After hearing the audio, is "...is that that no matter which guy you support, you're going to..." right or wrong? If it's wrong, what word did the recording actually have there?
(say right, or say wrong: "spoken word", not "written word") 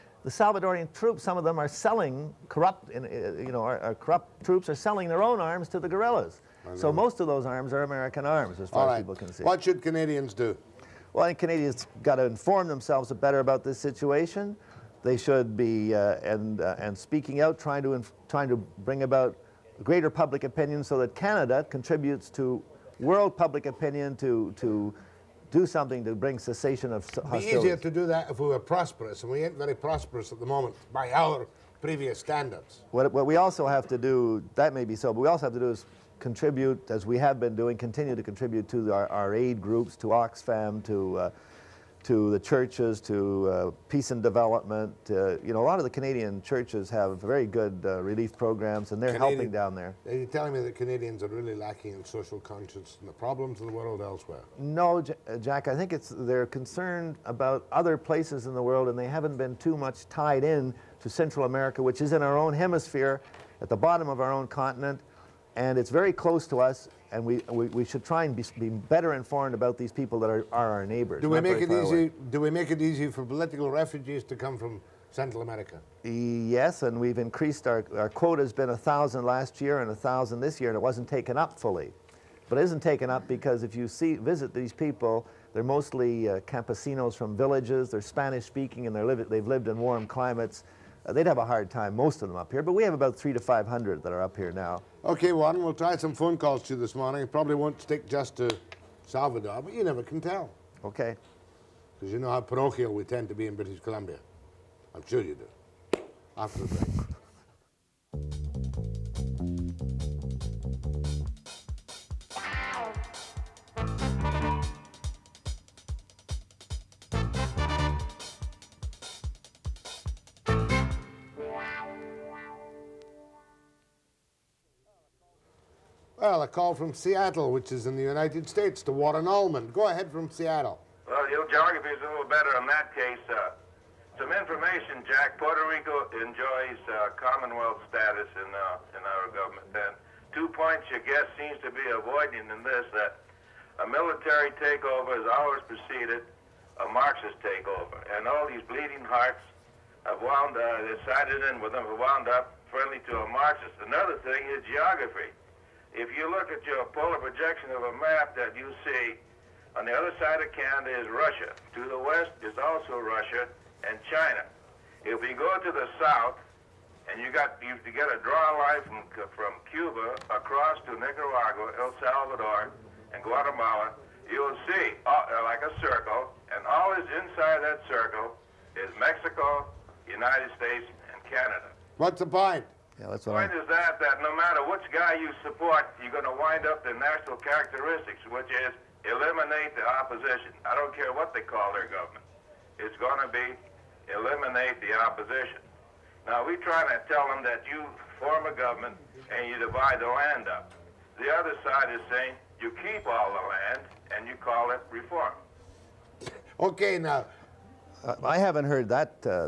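right.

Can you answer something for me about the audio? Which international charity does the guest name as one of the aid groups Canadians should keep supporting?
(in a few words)
Oxfam.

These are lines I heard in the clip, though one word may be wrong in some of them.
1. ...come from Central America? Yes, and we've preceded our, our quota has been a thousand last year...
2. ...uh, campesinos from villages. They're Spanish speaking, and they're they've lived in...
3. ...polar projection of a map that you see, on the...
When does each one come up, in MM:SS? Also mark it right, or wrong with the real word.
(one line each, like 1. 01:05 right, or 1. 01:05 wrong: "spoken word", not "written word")
1. 01:14 wrong: "increased", not "preceded"
2. 01:26 right
3. 02:36 right.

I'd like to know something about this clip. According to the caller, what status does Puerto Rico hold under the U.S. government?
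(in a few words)
Commonwealth status.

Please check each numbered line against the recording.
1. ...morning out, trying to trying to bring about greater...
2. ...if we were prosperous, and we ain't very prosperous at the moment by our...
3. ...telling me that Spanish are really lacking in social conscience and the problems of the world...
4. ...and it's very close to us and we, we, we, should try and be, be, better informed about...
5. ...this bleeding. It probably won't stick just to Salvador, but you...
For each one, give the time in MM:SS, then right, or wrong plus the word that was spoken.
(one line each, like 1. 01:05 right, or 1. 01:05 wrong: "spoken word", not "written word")
1. 00:16 wrong: "speaking", not "morning"
2. 00:28 right
3. 00:50 wrong: "Canadians", not "Spanish"
4. 01:05 right
5. 01:36 wrong: "morning", not "bleeding".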